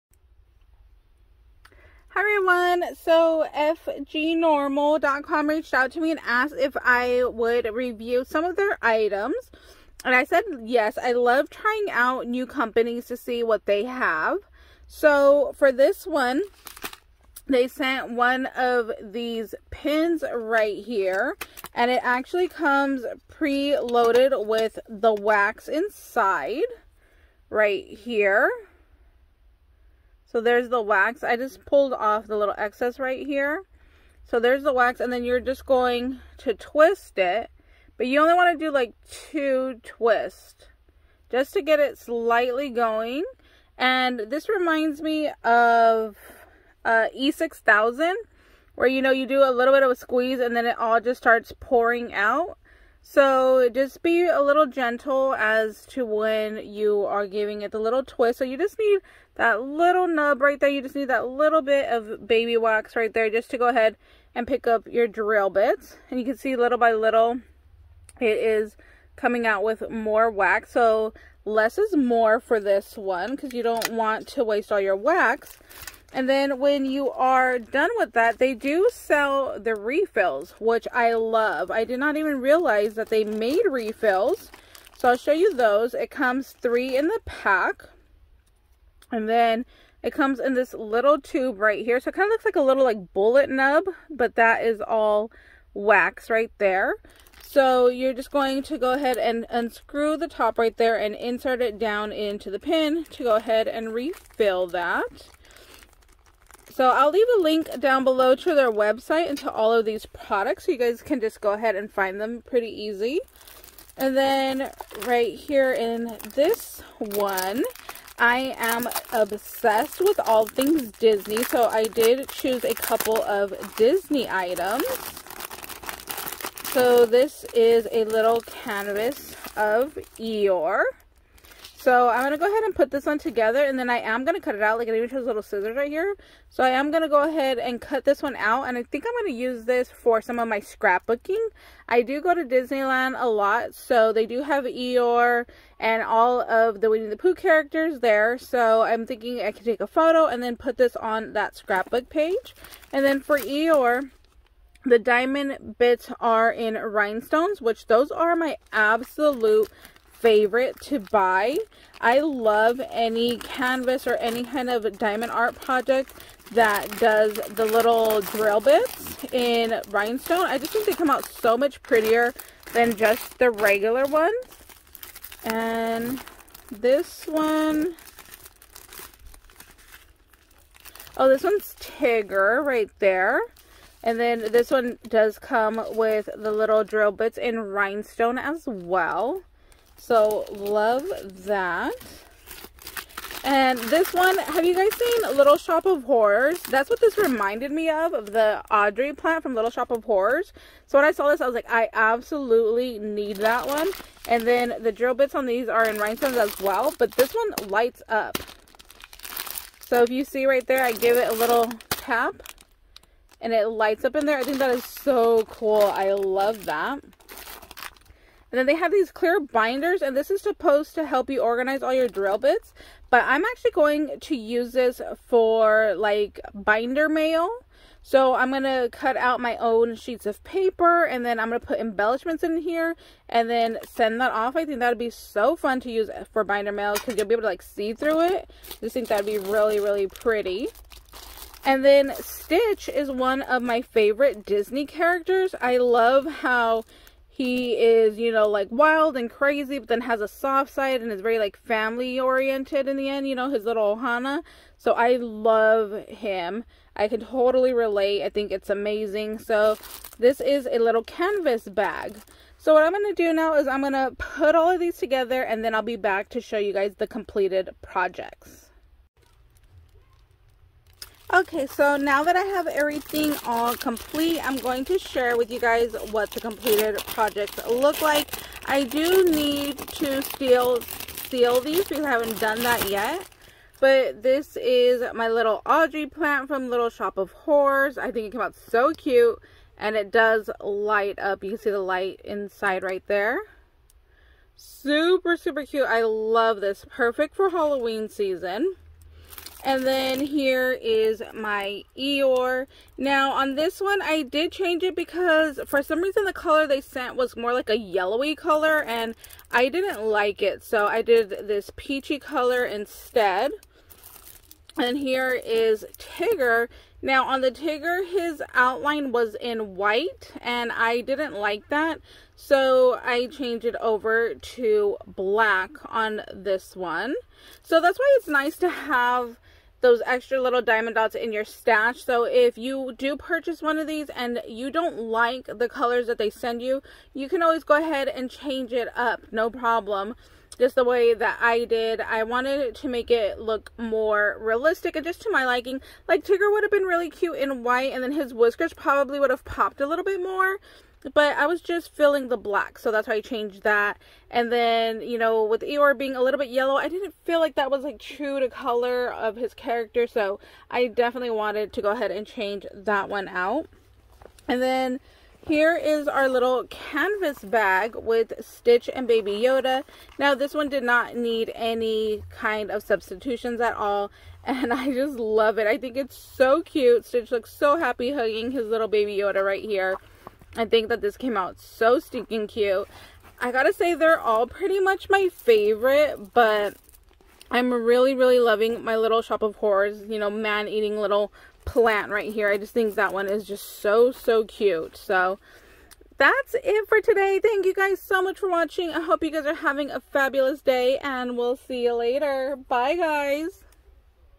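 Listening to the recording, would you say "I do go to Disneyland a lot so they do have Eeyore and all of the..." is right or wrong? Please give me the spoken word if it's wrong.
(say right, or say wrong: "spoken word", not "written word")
right.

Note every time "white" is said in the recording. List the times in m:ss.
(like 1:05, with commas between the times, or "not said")
5:19, 5:47.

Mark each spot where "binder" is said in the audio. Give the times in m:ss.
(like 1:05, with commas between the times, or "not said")
3:39, 3:46, 3:56.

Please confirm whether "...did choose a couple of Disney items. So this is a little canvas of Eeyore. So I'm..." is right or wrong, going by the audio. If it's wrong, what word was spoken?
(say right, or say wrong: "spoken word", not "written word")
right.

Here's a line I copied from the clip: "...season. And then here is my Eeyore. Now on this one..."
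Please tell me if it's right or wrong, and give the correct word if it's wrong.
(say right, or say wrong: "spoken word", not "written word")
right.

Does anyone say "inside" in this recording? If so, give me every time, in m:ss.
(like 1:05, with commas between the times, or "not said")
0:25, 4:52.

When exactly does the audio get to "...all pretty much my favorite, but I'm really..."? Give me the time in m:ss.
6:24.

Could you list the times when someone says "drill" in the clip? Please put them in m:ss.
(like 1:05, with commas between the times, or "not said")
1:05, 2:48, 3:06, 3:24, 3:42.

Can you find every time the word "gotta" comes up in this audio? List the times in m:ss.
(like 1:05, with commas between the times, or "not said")
6:23.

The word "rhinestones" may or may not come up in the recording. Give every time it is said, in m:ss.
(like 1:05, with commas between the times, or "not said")
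2:36, 2:49, 3:07, 3:25.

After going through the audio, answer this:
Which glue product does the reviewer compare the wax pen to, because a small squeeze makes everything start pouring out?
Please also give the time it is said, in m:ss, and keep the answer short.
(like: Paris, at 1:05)
E6000, at 0:47.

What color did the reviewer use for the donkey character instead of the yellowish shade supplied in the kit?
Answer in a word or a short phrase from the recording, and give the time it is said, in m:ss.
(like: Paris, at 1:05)
peachy, at 5:11.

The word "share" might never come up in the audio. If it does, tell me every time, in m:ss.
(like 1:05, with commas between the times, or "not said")
4:34.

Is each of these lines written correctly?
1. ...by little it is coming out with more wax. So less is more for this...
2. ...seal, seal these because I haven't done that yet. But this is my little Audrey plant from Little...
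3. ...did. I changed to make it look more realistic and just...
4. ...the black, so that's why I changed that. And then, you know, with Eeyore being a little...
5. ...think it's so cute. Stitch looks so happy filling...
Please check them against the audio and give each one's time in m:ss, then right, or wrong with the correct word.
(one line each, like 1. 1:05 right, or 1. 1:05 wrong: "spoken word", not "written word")
1. 1:06 right
2. 4:40 right
3. 5:41 wrong: "wanted", not "changed"
4. 5:52 right
5. 6:15 wrong: "hugging", not "filling".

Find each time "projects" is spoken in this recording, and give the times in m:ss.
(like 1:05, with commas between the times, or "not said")
2:45, 4:27, 4:37.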